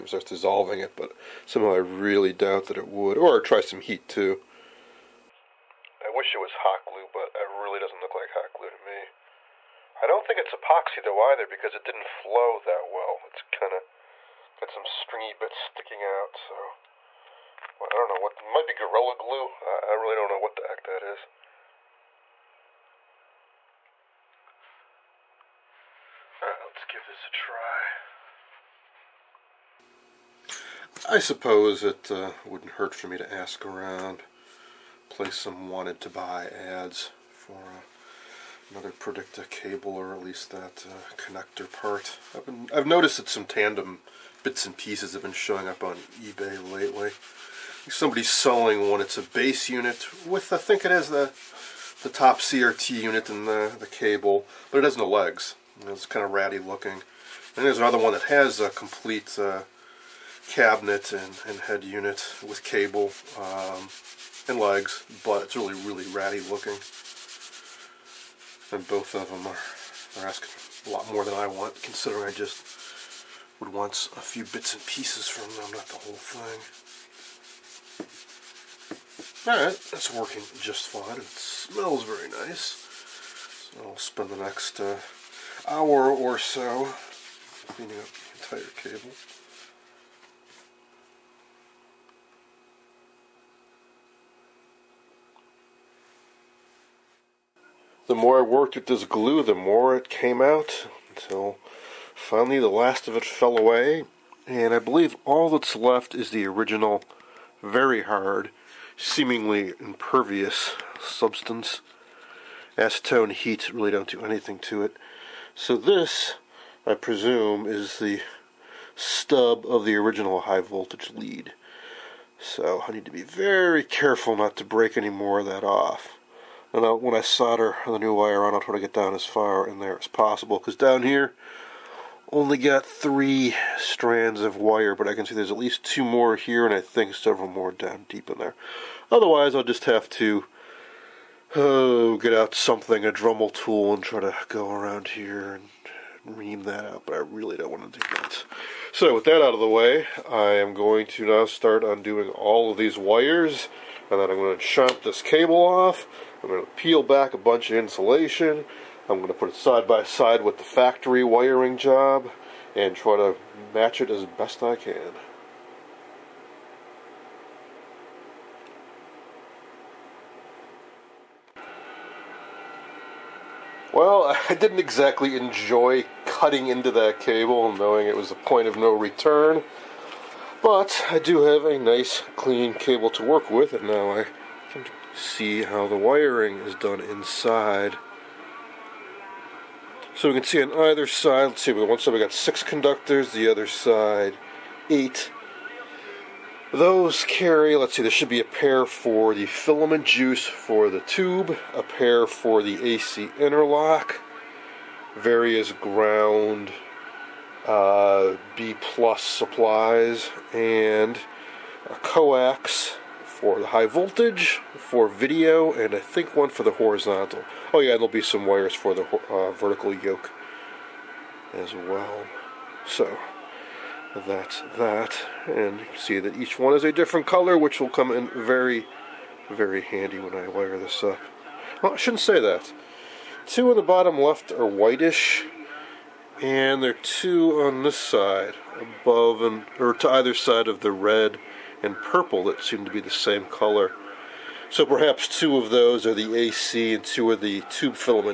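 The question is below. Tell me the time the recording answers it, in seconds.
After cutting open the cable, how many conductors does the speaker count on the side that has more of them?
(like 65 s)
194 s.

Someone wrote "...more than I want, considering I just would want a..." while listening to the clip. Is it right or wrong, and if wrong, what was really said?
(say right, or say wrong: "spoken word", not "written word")
right.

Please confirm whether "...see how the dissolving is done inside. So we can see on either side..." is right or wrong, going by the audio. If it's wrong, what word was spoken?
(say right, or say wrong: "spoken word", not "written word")
wrong: "wiring", not "dissolving".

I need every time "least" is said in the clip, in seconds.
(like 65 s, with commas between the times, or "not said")
40 s, 135 s.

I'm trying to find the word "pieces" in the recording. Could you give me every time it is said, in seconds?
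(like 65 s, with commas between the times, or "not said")
44 s, 74 s.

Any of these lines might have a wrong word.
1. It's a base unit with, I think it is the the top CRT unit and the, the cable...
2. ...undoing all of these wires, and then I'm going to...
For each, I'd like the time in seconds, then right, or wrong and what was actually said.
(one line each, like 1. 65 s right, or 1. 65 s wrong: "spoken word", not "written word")
1. 49 s right
2. 151 s right.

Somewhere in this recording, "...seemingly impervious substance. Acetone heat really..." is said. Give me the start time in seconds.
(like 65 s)
108 s.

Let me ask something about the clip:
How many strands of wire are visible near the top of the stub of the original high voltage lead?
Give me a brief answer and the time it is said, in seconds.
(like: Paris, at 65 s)
3, at 132 s.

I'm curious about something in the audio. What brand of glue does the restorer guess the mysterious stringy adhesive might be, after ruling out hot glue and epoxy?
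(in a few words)
Gorilla Glue.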